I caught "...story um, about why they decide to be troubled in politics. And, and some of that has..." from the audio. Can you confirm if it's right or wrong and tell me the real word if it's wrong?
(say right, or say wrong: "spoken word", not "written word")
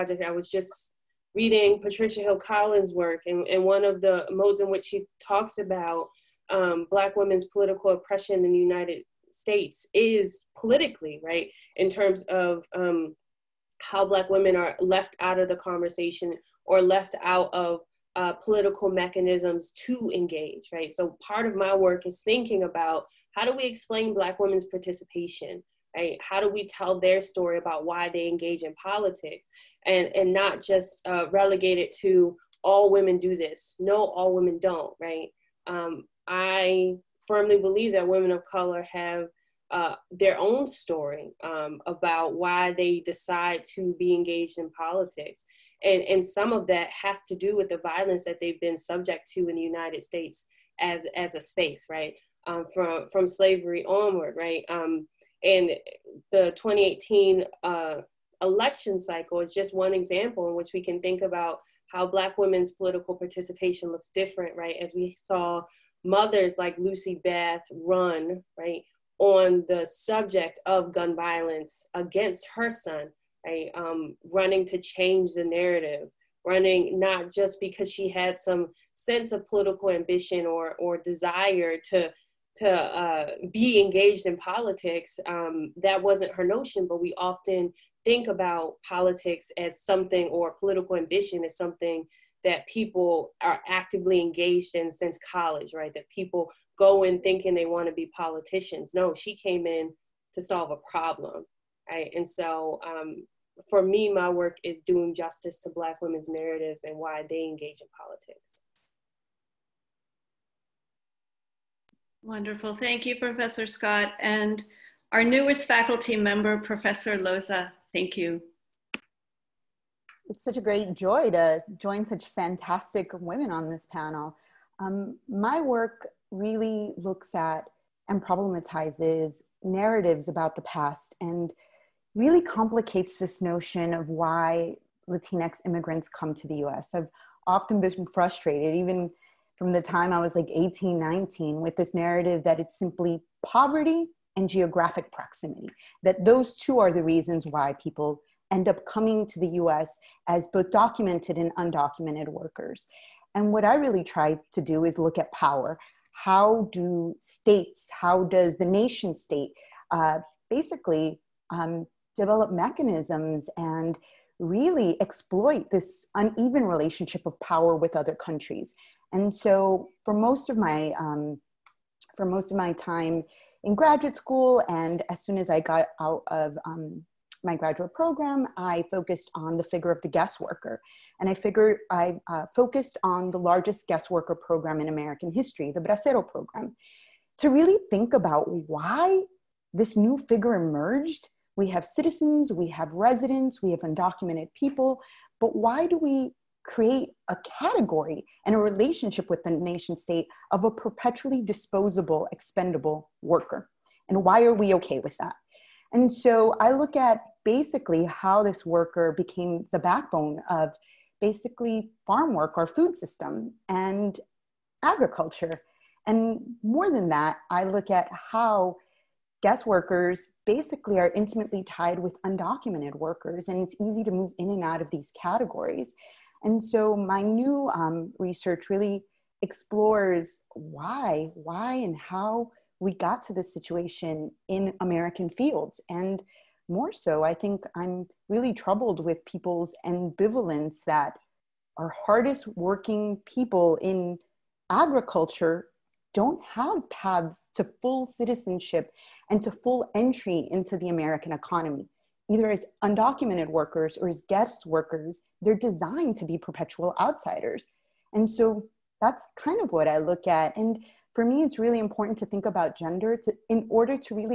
wrong: "engaged", not "troubled".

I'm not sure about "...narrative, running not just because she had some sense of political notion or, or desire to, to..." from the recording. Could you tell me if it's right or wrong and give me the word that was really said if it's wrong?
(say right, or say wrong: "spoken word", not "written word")
wrong: "ambition", not "notion".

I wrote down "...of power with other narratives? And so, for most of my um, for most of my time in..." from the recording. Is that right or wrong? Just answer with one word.
wrong.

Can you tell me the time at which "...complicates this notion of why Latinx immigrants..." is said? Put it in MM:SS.
02:12.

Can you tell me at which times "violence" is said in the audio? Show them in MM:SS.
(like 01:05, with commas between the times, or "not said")
00:47, 01:11.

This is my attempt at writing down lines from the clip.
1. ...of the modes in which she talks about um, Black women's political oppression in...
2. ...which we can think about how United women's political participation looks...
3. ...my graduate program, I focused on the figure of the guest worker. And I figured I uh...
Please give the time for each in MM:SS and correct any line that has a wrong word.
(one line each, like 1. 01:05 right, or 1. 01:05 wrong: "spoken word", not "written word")
1. 00:03 right
2. 01:00 wrong: "Black", not "United"
3. 02:57 right.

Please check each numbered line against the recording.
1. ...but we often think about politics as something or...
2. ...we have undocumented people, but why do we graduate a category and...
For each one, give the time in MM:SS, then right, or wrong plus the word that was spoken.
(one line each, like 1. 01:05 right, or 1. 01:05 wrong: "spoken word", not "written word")
1. 01:26 right
2. 03:13 wrong: "create", not "graduate".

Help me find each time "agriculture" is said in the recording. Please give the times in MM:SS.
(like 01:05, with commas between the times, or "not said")
03:34, 04:04.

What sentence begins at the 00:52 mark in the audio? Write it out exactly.
Um, from, from slavery onward, right?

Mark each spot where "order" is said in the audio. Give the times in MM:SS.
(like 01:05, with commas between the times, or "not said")
04:23.